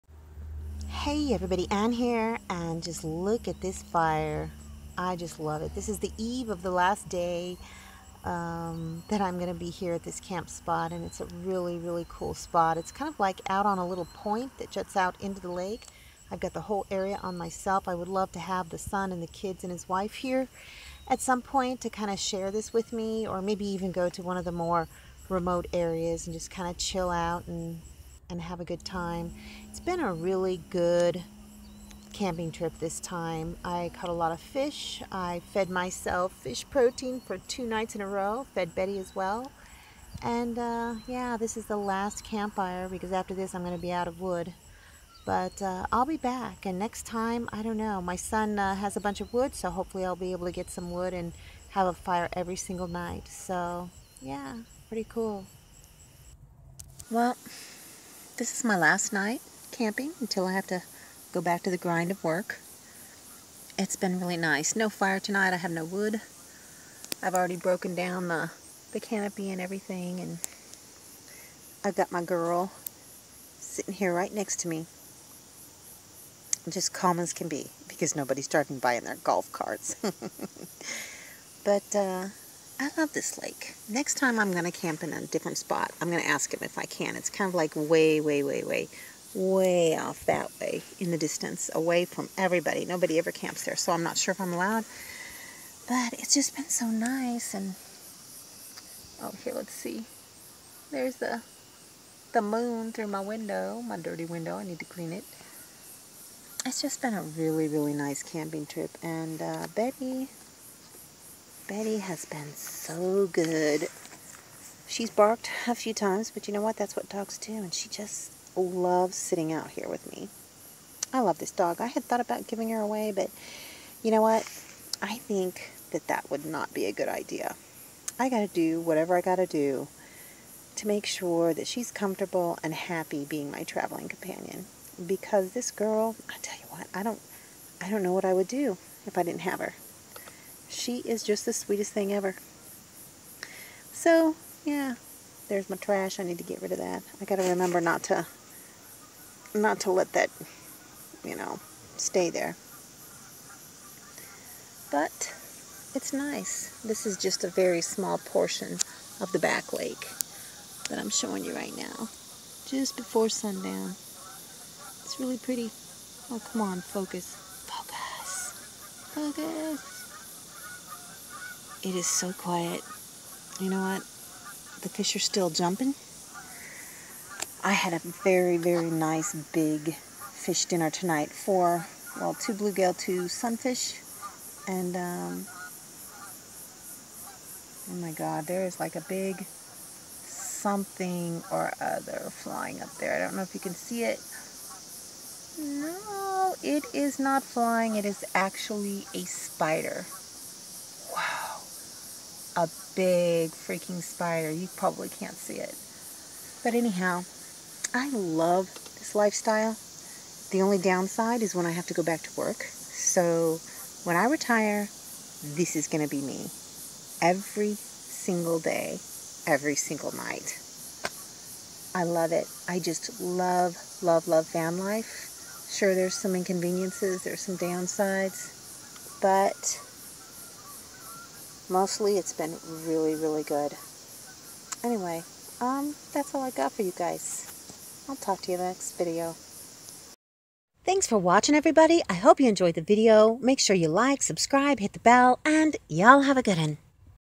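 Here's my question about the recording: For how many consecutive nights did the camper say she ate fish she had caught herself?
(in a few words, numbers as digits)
2.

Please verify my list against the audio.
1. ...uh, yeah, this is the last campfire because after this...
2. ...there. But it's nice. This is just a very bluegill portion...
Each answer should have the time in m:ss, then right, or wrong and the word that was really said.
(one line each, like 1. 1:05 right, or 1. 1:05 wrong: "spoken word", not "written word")
1. 0:40 right
2. 2:32 wrong: "small", not "bluegill".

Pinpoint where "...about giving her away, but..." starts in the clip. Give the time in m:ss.
2:02.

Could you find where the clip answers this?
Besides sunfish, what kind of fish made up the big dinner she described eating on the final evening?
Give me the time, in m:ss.
3:02.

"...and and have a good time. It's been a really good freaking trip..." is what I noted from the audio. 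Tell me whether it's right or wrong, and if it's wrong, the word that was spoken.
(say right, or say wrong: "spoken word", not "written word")
wrong: "camping", not "freaking".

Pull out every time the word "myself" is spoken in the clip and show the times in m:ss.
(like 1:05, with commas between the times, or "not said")
0:17, 0:35.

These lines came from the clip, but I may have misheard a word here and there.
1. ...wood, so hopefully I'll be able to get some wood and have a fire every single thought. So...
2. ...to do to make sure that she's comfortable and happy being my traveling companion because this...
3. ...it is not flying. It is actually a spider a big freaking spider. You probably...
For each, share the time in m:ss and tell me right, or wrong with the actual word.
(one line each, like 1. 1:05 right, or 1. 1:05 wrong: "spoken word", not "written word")
1. 0:49 wrong: "night", not "thought"
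2. 2:09 right
3. 3:16 right.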